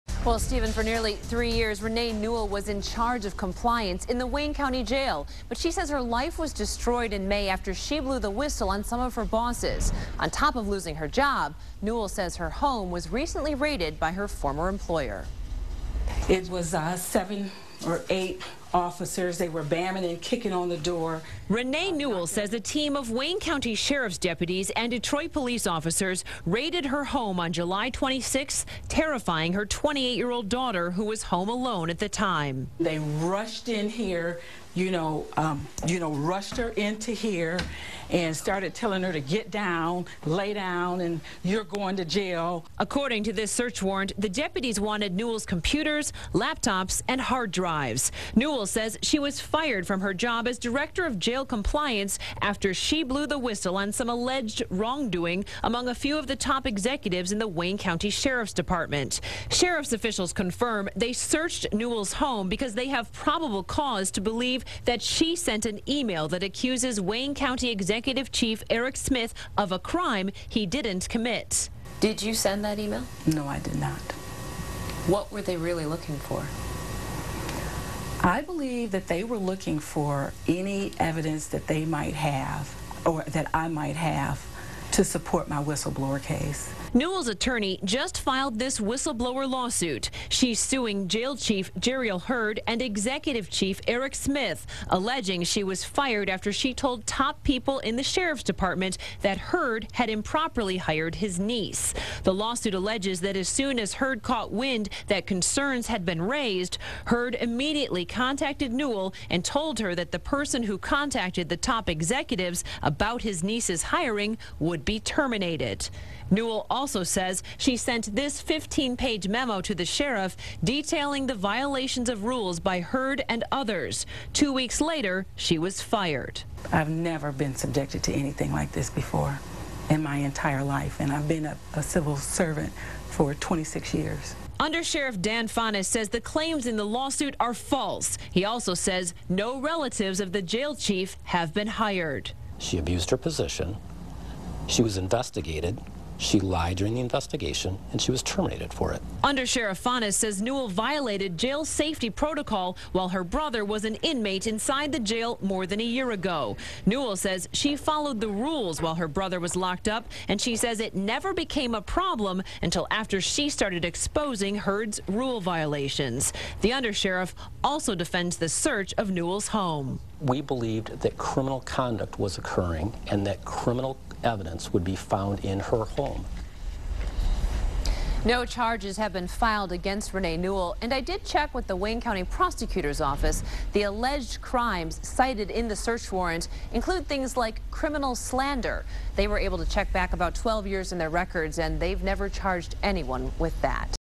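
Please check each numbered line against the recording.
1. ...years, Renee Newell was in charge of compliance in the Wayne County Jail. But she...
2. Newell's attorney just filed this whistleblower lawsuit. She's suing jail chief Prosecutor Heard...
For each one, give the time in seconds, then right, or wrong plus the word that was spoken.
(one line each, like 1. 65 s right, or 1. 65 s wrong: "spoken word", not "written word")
1. 1 s right
2. 86 s wrong: "Jeriel", not "Prosecutor".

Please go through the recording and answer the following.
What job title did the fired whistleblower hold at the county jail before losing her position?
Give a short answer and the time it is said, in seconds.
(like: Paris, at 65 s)
Director of jail compliance, at 50 s.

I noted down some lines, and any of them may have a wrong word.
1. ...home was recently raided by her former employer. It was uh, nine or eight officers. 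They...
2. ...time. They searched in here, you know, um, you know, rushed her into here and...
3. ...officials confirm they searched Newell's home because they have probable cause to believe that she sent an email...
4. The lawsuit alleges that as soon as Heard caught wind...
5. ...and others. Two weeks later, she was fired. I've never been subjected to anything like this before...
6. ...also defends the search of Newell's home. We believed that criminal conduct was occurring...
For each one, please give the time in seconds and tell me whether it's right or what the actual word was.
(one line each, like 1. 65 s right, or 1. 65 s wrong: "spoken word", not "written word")
1. 12 s wrong: "seven", not "nine"
2. 32 s wrong: "rushed", not "searched"
3. 59 s right
4. 102 s right
5. 123 s right
6. 167 s right.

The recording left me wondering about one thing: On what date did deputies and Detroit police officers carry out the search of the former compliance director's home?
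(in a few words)
July 26.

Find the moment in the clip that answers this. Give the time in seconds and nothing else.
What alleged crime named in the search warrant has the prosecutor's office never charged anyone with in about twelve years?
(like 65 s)
187 s.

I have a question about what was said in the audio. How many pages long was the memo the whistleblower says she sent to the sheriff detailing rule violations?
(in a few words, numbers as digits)
15.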